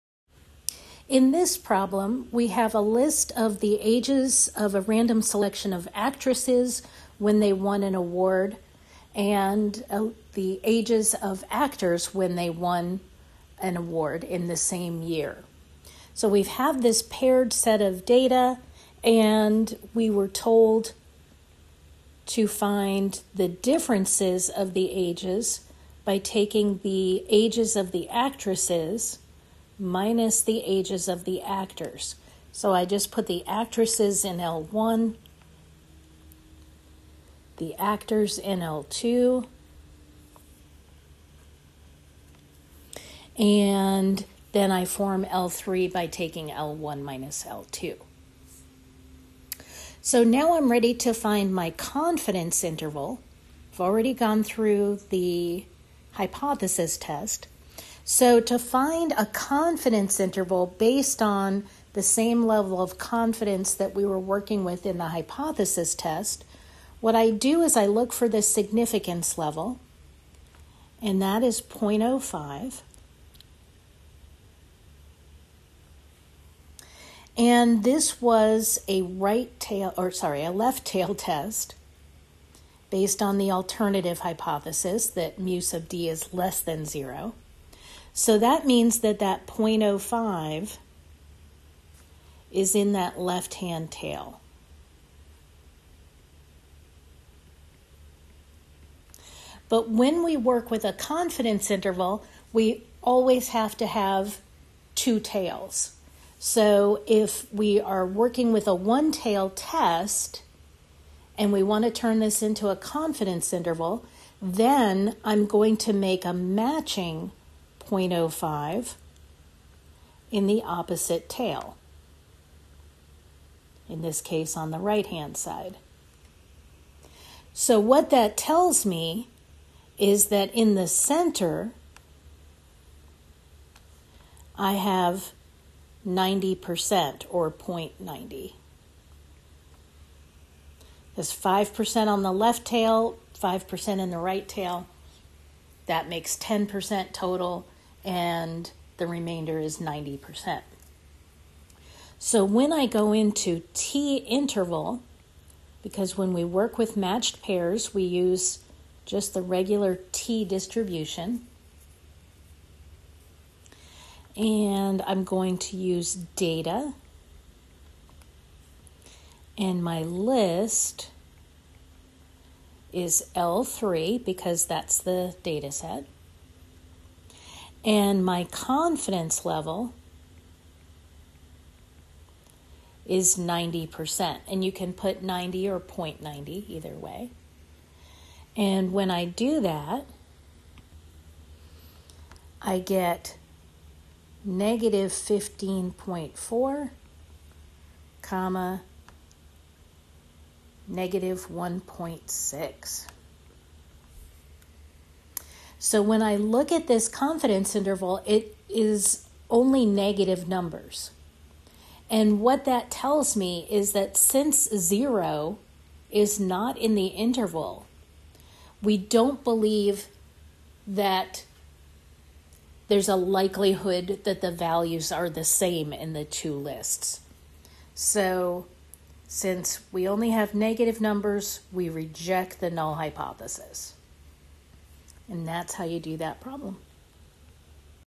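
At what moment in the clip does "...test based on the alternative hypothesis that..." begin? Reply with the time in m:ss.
1:21.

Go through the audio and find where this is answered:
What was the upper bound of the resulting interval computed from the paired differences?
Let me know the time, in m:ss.
3:20.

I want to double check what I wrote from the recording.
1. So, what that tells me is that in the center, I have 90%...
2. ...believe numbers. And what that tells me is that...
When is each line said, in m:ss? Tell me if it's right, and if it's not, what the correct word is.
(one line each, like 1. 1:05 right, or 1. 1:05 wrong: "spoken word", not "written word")
1. 2:07 right
2. 3:29 wrong: "negative", not "believe".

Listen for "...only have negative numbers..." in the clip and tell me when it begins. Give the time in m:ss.
3:50.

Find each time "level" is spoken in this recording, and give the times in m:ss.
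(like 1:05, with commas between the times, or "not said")
1:02, 1:09, 2:59.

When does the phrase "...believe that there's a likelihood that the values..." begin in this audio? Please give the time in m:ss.
3:39.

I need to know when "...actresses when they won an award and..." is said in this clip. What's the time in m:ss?
0:05.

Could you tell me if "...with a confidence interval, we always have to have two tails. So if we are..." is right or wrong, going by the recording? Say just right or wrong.
right.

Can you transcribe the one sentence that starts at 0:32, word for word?
So I just put the actresses in L1, the actors in L2, and then I form L3 by taking L1 minus L2.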